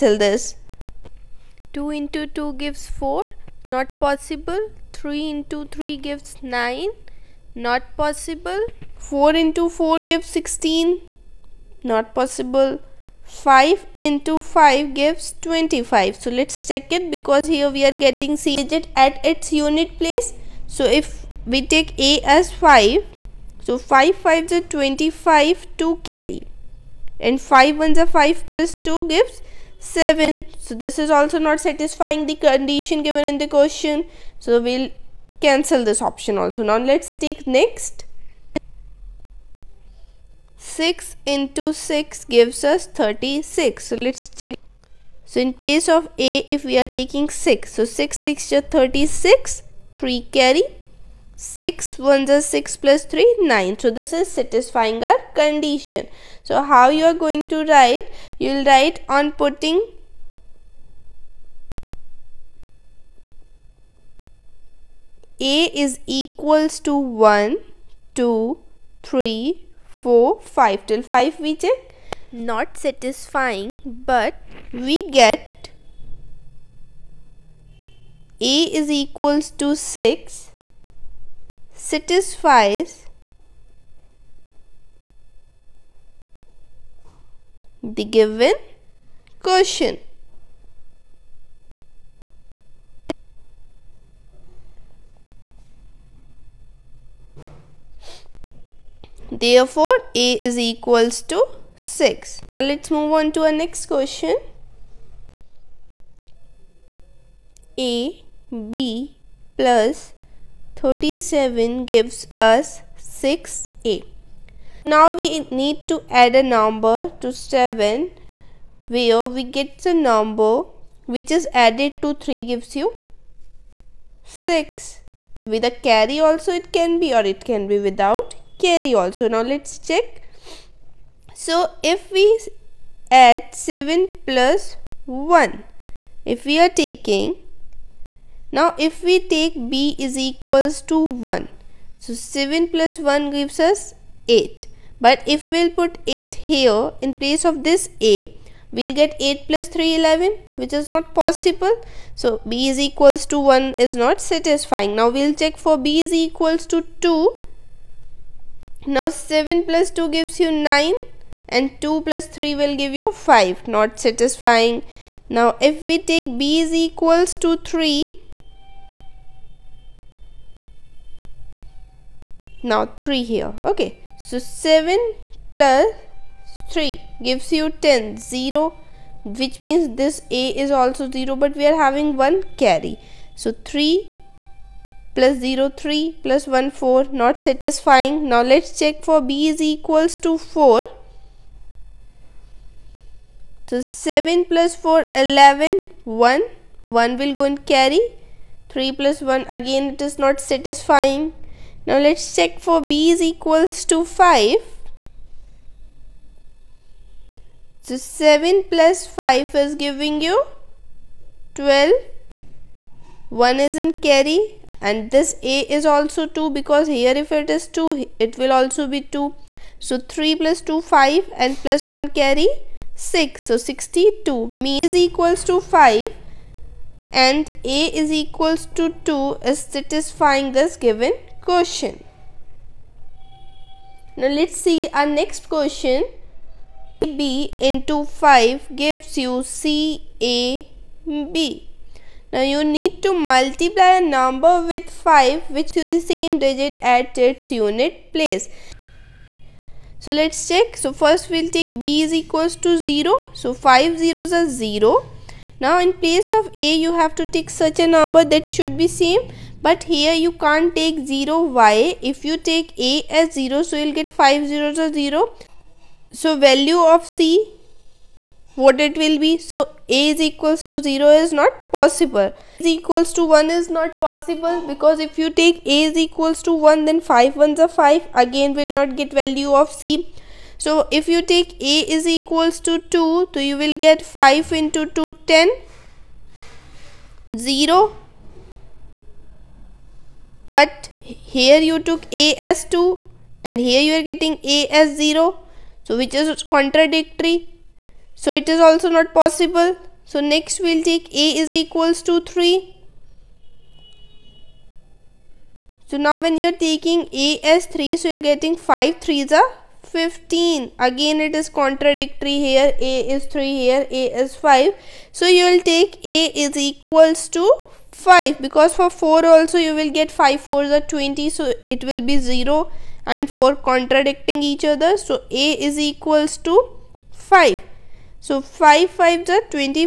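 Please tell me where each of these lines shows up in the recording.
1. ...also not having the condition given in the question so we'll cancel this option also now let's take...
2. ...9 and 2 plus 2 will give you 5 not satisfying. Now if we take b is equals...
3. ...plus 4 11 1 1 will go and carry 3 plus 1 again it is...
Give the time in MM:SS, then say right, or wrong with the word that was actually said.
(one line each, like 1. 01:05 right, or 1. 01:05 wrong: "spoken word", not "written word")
1. 00:31 wrong: "satisfying", not "having"
2. 02:40 wrong: "3", not "2"
3. 03:14 right.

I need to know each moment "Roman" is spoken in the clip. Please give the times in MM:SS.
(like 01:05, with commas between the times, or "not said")
not said.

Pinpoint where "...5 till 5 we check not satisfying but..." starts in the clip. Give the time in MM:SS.
01:10.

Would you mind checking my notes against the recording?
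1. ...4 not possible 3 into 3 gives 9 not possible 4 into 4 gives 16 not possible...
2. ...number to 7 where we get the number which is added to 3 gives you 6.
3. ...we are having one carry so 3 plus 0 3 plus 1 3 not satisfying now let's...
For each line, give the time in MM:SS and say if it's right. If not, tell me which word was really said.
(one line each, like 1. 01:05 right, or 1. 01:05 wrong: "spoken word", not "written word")
1. 00:02 right
2. 01:56 right
3. 03:01 wrong: "4", not "3".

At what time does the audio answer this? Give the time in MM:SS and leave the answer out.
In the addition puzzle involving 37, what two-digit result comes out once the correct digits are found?
03:43.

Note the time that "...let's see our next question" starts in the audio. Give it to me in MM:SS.
03:54.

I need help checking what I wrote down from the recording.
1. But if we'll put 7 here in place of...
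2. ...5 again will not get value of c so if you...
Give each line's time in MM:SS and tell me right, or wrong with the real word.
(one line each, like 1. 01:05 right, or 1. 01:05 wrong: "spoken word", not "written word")
1. 02:25 wrong: "8", not "7"
2. 04:37 right.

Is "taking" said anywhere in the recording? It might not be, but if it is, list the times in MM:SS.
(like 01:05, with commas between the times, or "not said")
00:46, 02:16, 05:06.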